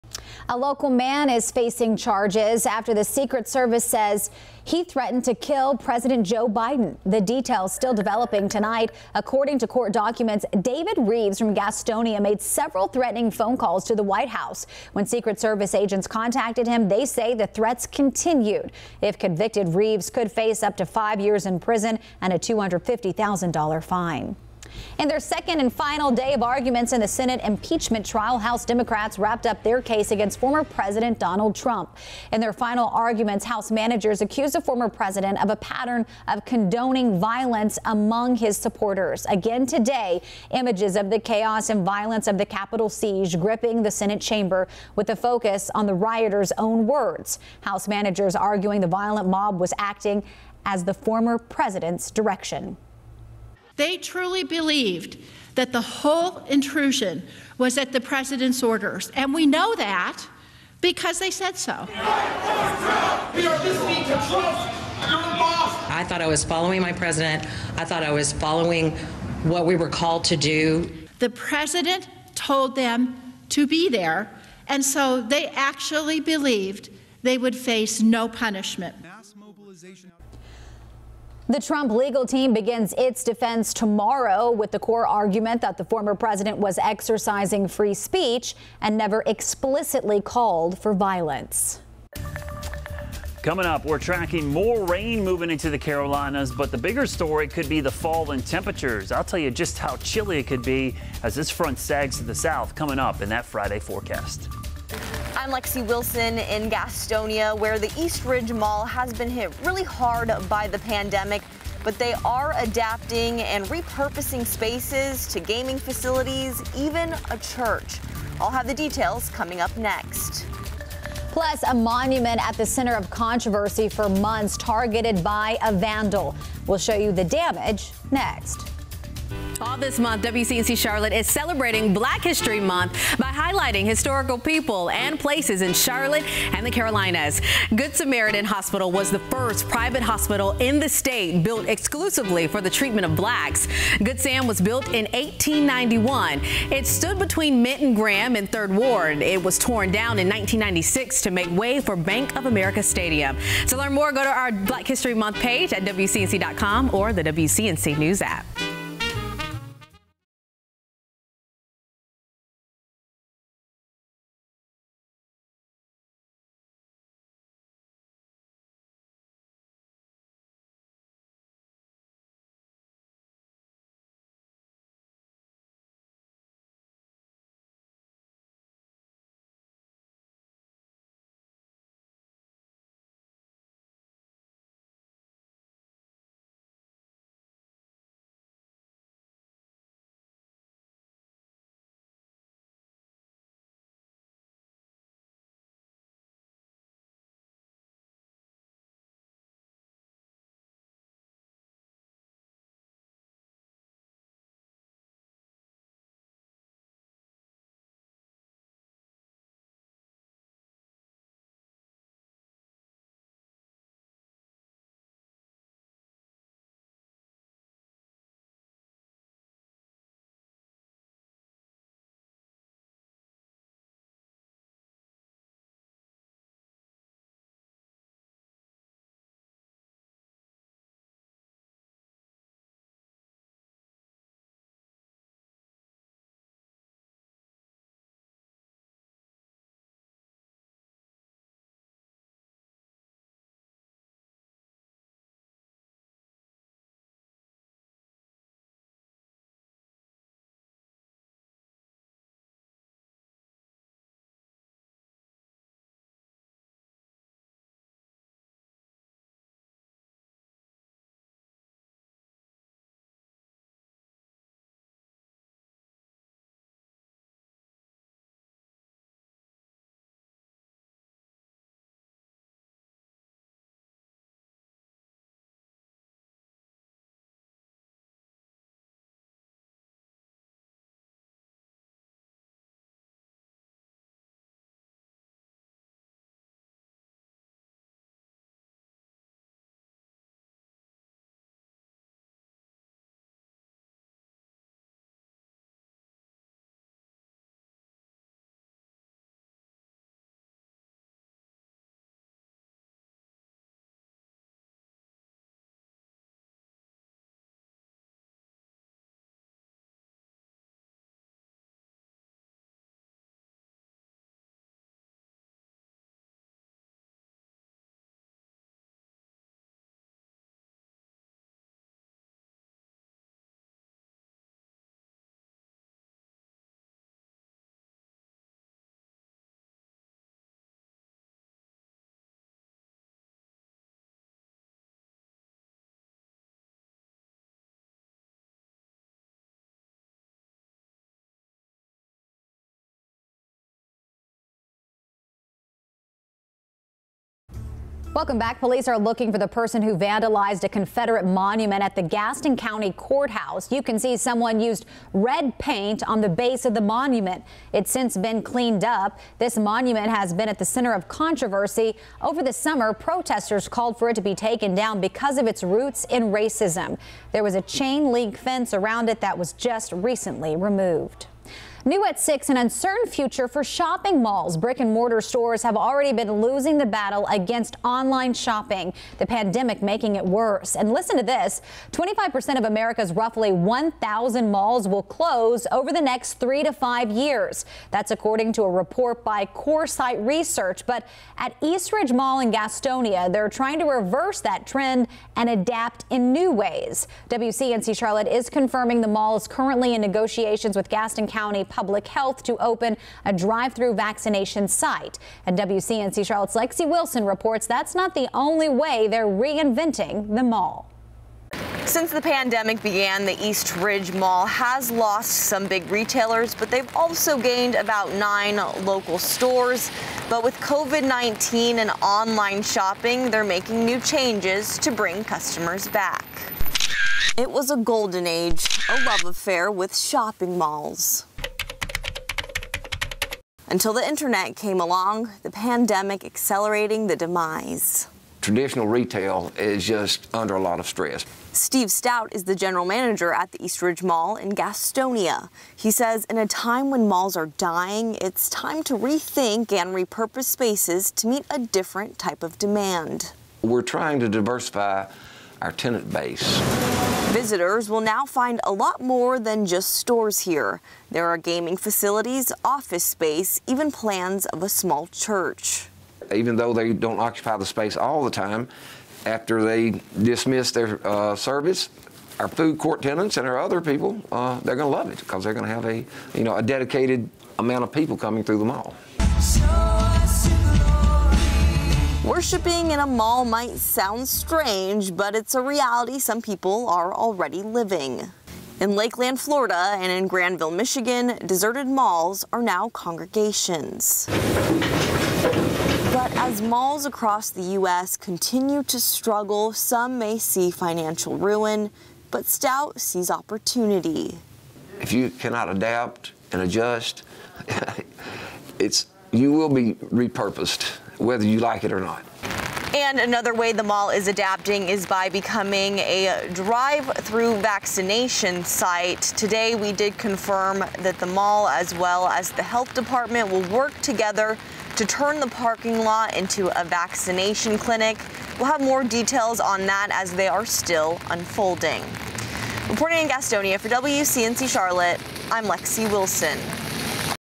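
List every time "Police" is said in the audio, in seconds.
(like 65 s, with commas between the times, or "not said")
348 s.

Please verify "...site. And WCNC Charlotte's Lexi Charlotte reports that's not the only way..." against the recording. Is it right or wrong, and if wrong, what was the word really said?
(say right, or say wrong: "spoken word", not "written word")
wrong: "Wilson", not "Charlotte".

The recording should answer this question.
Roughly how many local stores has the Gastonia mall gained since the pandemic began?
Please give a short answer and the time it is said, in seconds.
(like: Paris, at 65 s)
9, at 418 s.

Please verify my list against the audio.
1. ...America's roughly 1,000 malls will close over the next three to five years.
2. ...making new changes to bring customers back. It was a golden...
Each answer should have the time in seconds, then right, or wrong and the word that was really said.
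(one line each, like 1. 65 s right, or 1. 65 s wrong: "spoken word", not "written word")
1. 382 s right
2. 423 s right.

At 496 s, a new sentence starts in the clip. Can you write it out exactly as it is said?
But as malls across the U.S.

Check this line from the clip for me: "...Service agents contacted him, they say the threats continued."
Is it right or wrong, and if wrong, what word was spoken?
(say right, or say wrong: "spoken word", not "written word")
right.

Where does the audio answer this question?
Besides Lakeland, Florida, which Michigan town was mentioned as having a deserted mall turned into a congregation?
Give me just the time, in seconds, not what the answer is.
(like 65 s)
490 s.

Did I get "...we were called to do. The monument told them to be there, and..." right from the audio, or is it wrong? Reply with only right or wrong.
wrong.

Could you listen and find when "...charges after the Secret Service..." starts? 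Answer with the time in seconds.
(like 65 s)
1 s.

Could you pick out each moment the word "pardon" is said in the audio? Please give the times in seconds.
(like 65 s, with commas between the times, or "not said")
not said.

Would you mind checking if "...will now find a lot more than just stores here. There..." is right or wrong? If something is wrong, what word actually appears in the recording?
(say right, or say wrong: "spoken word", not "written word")
right.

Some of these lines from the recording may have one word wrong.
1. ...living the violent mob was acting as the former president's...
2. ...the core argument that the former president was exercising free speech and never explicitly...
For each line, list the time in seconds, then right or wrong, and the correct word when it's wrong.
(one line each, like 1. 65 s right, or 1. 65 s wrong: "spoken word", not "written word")
1. 48 s wrong: "arguing", not "living"
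2. 84 s right.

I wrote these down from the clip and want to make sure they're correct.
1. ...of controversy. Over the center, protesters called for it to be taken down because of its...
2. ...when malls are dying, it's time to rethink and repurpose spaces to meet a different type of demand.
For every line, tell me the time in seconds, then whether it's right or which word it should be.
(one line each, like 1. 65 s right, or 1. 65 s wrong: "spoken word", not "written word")
1. 360 s wrong: "summer", not "center"
2. 446 s right.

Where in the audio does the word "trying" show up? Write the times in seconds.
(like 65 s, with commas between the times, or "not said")
393 s, 453 s.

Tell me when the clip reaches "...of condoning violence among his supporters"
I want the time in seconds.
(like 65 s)
36 s.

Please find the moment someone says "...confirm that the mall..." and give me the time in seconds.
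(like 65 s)
520 s.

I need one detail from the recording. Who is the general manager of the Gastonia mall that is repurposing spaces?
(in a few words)
Steve Stout.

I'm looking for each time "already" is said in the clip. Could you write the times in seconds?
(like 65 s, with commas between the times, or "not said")
375 s, 487 s.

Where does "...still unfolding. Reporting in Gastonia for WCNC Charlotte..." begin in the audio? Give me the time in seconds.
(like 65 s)
530 s.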